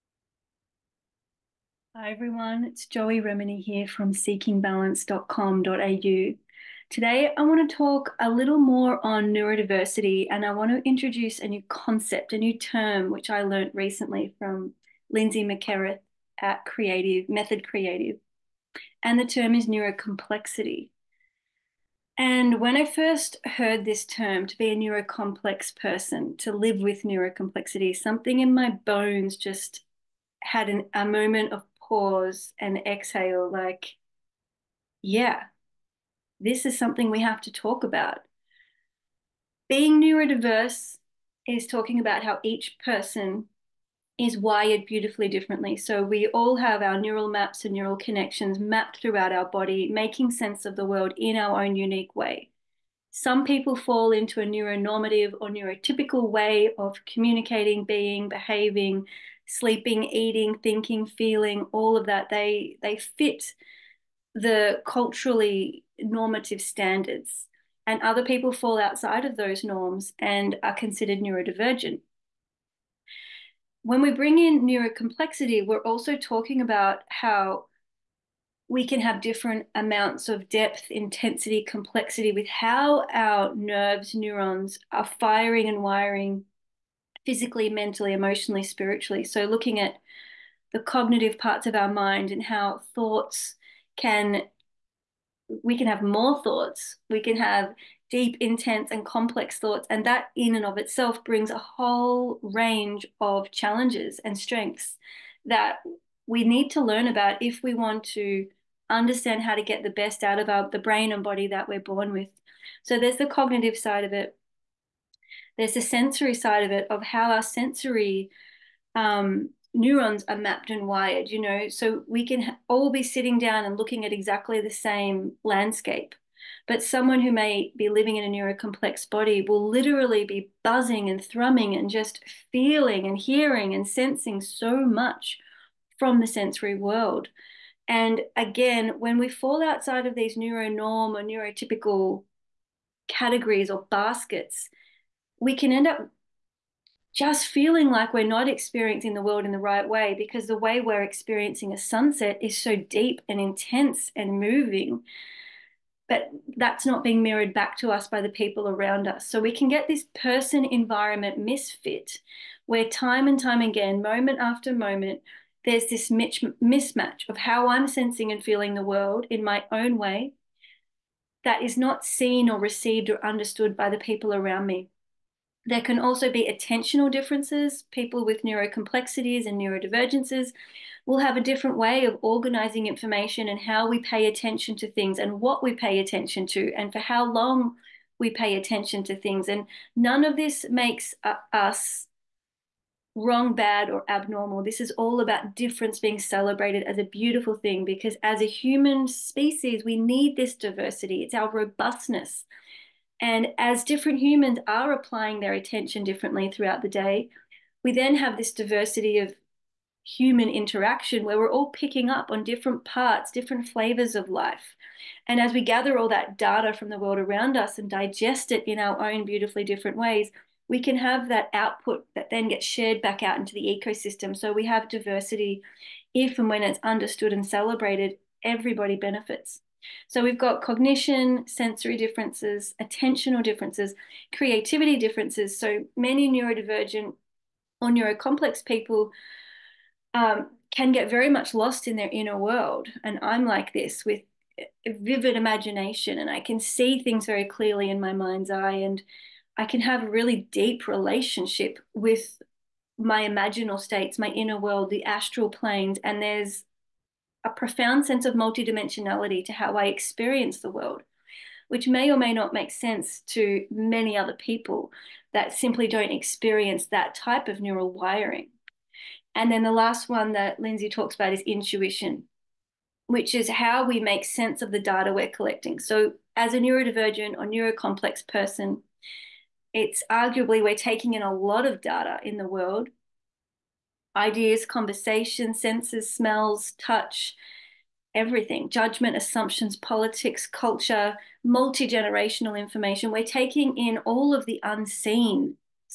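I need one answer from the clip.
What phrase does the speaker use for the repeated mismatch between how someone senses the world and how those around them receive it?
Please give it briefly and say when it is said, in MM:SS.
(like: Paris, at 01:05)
person environment misfit, at 02:40.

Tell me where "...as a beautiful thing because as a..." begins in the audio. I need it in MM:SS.
03:16.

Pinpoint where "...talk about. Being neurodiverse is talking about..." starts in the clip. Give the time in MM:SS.
00:37.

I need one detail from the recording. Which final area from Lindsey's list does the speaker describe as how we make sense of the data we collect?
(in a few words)
intuition.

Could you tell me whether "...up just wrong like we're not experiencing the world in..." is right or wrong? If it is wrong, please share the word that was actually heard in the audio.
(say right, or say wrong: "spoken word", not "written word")
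wrong: "feeling", not "wrong".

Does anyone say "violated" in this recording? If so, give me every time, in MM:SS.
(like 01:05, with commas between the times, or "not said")
not said.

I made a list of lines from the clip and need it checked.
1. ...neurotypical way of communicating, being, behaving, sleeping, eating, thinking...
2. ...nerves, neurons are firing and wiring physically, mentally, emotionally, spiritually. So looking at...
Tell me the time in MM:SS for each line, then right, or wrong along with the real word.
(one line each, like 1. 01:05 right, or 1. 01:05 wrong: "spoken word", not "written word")
1. 00:55 right
2. 01:23 right.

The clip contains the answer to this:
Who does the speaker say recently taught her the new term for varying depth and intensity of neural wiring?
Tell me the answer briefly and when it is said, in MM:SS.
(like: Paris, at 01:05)
Lindsey Mackereth, at 00:15.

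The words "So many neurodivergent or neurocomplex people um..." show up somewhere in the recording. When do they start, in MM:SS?
03:55.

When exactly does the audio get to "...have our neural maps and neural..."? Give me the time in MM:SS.
00:46.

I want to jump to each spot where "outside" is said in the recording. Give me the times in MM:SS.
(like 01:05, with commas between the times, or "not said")
01:08, 02:19.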